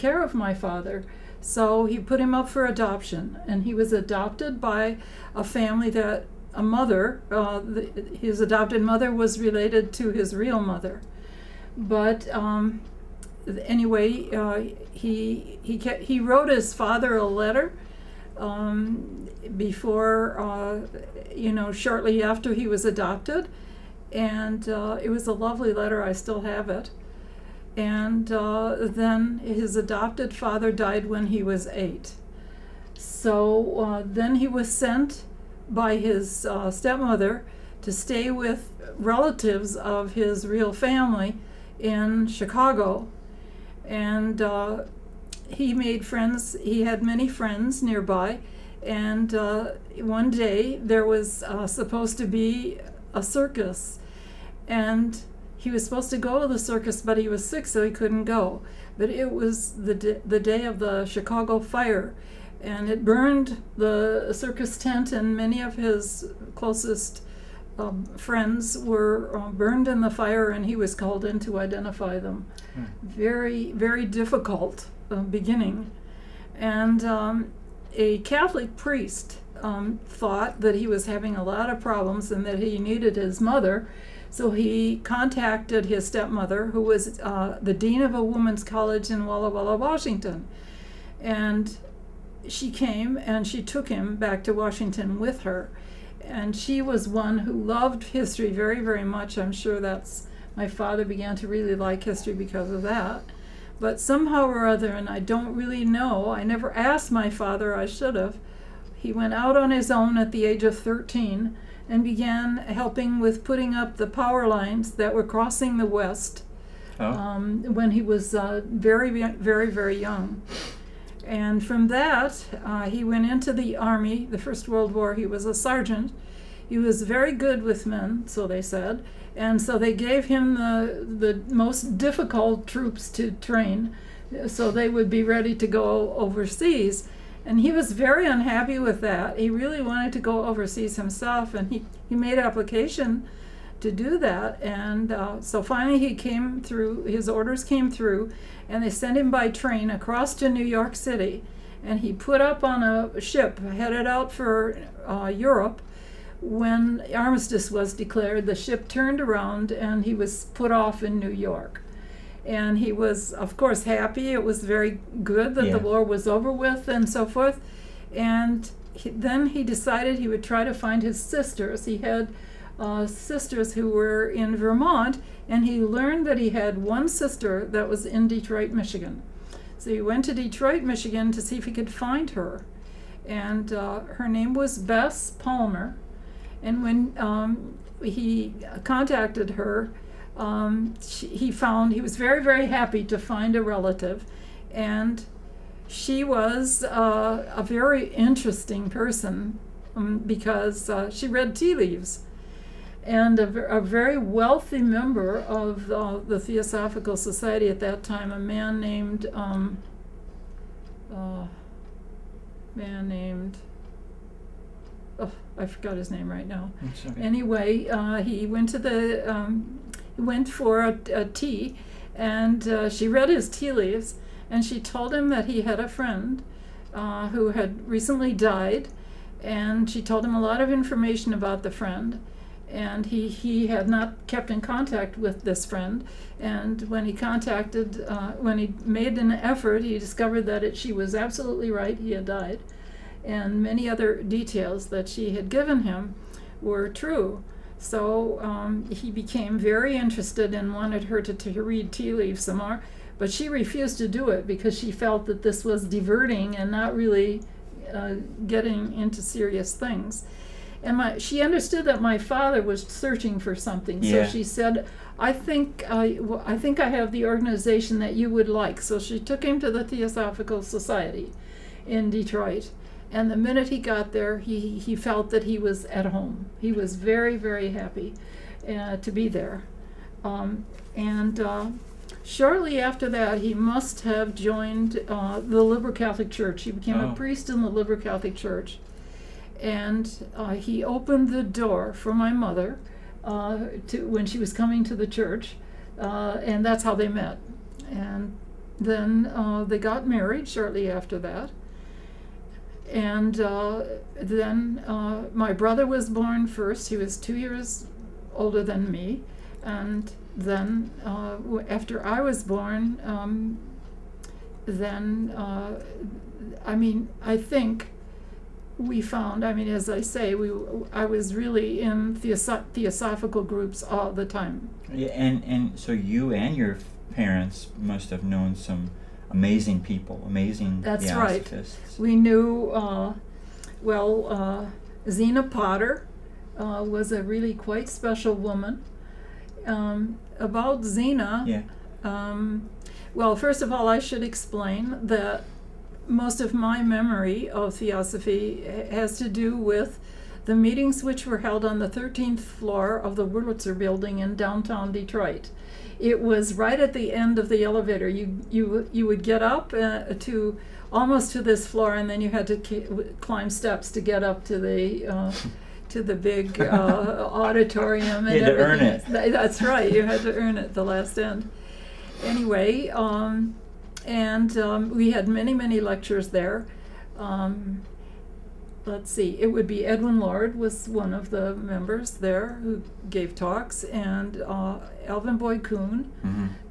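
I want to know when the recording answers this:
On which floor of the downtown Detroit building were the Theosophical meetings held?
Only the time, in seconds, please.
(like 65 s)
351 s.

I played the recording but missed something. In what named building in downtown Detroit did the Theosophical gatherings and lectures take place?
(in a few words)
Wurlitzer building.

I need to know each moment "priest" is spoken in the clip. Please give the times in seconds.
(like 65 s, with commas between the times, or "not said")
78 s, 287 s.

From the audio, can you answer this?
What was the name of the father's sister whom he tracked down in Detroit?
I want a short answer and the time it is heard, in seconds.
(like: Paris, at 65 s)
Bess Palmer, at 184 s.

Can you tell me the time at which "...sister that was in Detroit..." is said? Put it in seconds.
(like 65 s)
177 s.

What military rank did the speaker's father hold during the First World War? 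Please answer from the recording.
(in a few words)
Sergeant.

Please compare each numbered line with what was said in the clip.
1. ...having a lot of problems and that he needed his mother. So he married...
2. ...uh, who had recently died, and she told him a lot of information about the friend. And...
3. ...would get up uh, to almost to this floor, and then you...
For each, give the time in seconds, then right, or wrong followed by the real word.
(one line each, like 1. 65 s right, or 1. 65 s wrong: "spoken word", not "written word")
1. 81 s wrong: "contacted", not "married"
2. 226 s right
3. 359 s right.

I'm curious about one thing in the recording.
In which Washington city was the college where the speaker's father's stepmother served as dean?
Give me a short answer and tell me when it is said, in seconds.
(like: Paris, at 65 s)
Walla Walla, at 89 s.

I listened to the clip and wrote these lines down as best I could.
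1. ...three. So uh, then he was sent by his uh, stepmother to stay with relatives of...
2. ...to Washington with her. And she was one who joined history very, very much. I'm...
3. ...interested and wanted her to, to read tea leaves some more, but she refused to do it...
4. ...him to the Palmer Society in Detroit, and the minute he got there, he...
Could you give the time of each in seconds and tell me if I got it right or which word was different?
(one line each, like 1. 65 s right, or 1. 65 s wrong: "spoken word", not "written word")
1. 31 s wrong: "eight", not "three"
2. 94 s wrong: "loved", not "joined"
3. 249 s right
4. 269 s wrong: "Theosophical", not "Palmer".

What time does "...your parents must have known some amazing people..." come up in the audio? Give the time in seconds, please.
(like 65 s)
326 s.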